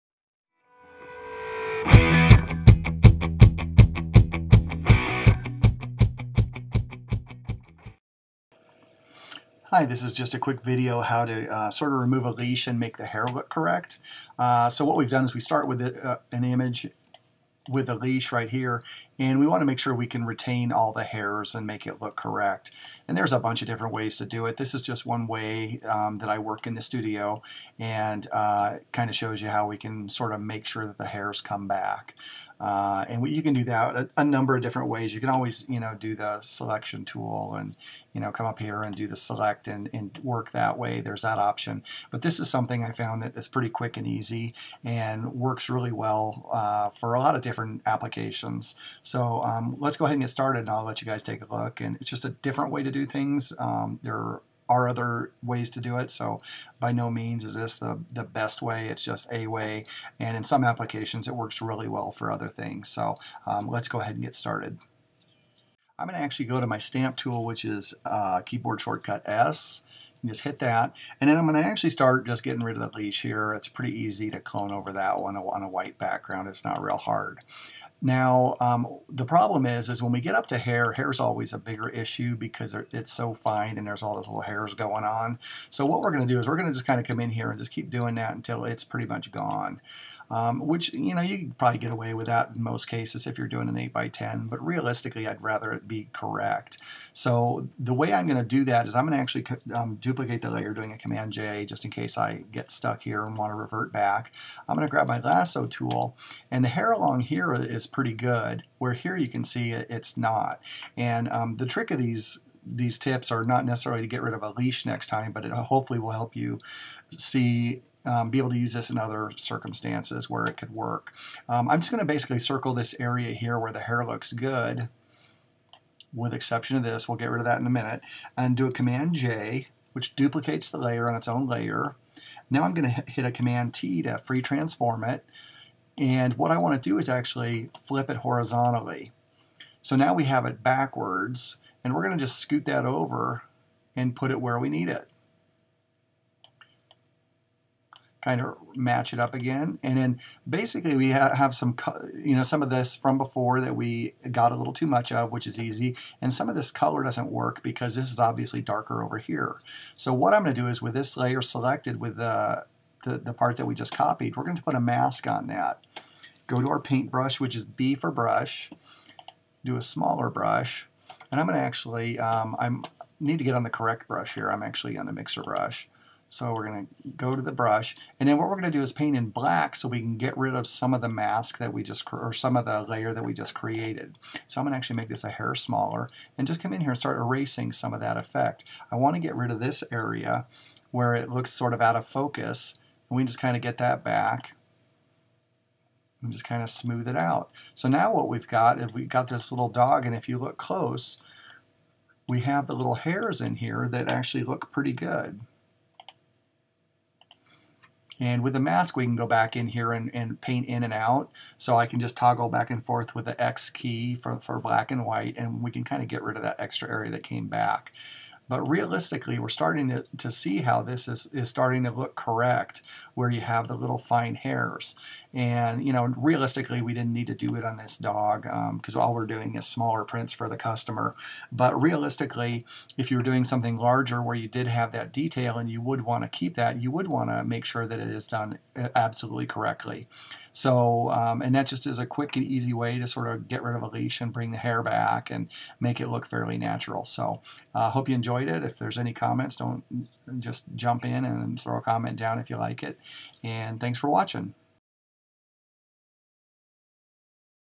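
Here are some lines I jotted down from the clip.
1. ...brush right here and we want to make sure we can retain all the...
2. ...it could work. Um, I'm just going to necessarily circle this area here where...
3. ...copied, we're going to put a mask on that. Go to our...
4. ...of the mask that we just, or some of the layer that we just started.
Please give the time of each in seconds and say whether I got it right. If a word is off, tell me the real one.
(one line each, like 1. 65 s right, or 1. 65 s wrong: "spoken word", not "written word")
1. 17 s wrong: "leash", not "brush"
2. 120 s wrong: "basically", not "necessarily"
3. 163 s right
4. 180 s wrong: "created", not "started".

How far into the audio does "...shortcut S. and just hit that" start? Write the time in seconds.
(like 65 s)
68 s.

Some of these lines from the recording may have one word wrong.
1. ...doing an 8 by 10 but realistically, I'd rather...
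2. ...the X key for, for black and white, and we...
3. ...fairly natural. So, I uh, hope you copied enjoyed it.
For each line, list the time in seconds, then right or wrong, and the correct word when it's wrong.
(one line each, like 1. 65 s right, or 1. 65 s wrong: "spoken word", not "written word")
1. 93 s right
2. 213 s right
3. 246 s wrong: "enjoyed", not "copied".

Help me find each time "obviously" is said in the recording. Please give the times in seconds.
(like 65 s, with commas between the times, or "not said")
158 s.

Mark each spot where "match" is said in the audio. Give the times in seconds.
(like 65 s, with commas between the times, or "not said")
148 s.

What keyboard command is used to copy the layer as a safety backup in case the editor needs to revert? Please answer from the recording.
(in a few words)
Command-J.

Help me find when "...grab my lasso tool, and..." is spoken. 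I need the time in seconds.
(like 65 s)
104 s.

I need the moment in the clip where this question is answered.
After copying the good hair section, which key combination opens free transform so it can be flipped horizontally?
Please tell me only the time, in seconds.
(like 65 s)
133 s.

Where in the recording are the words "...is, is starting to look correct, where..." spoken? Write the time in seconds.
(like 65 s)
221 s.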